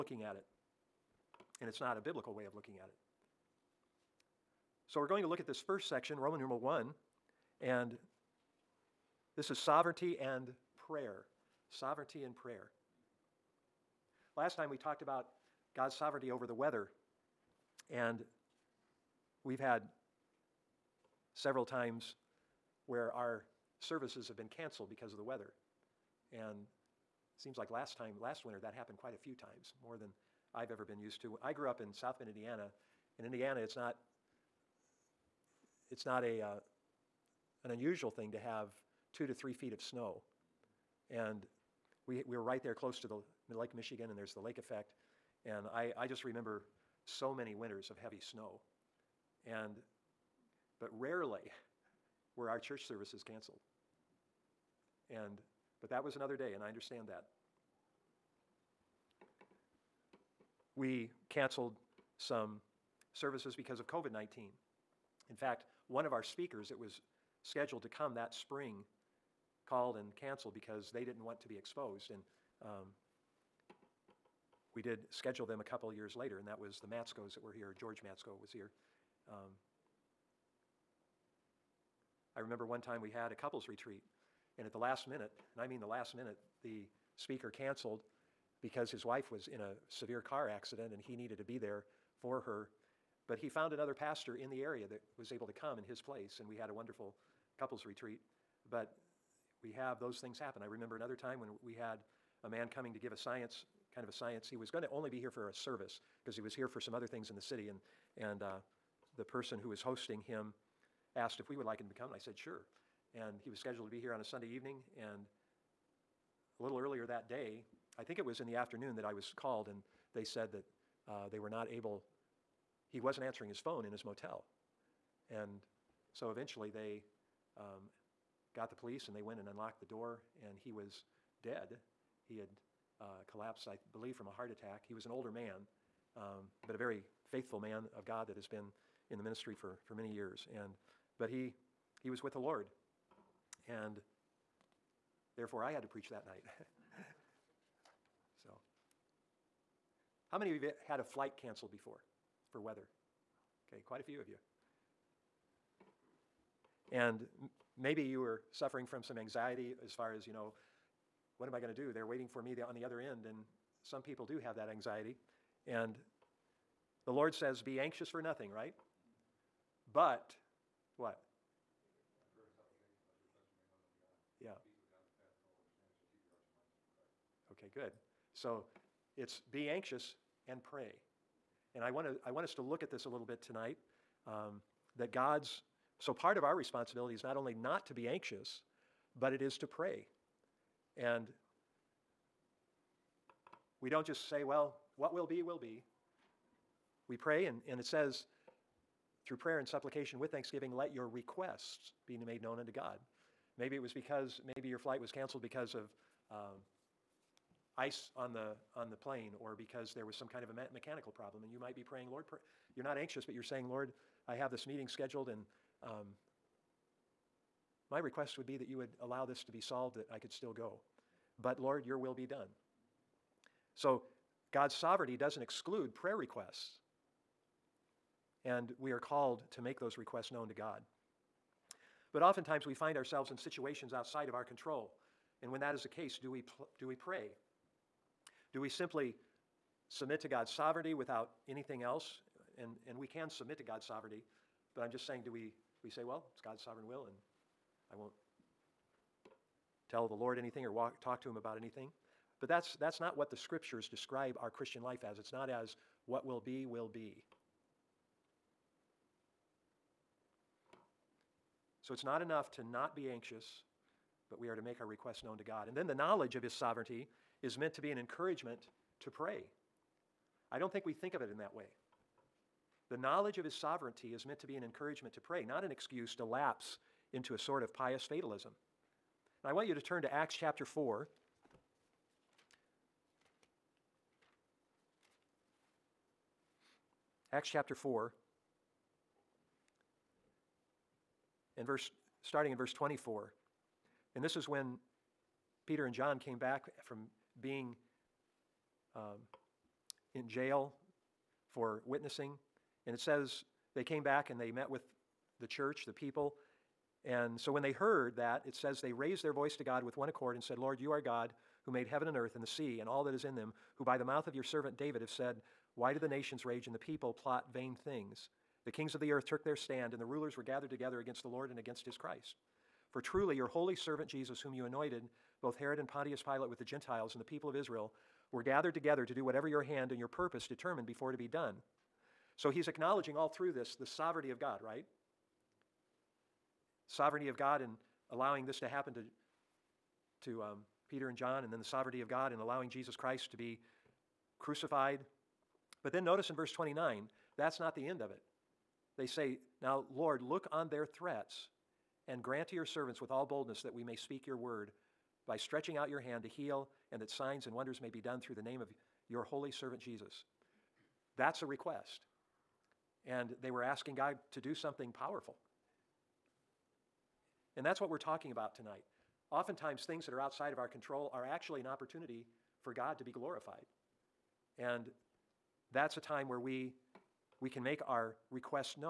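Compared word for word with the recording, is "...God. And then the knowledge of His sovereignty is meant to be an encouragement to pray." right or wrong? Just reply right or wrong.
right.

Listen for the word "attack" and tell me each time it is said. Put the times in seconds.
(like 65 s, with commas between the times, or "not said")
134 s.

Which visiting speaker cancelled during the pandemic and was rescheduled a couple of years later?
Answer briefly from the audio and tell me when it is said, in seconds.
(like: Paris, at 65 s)
George Matsko, at 77 s.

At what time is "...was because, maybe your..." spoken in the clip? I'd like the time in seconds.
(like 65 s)
203 s.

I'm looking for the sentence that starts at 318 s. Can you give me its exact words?
The kings of the earth took their stand, and the rulers were gathered together against the Lord and against his Christ.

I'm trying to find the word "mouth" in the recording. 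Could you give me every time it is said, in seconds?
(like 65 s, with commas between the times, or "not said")
314 s.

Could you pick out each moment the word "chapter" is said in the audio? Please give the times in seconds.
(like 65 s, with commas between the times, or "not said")
280 s, 287 s.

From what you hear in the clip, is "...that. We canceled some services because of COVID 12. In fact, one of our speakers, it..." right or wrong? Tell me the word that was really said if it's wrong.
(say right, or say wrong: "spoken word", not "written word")
wrong: "19", not "12".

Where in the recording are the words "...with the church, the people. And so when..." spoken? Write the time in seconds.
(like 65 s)
304 s.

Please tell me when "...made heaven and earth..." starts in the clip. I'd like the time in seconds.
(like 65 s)
311 s.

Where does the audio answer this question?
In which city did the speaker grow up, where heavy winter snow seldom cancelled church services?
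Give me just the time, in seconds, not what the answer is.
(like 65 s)
31 s.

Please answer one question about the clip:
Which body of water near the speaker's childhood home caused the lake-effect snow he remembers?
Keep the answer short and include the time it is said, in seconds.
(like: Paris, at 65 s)
Lake Michigan, at 43 s.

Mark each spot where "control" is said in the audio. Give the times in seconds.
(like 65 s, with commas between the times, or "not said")
234 s, 370 s.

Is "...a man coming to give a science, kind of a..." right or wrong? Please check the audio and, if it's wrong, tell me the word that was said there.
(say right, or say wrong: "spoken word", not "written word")
right.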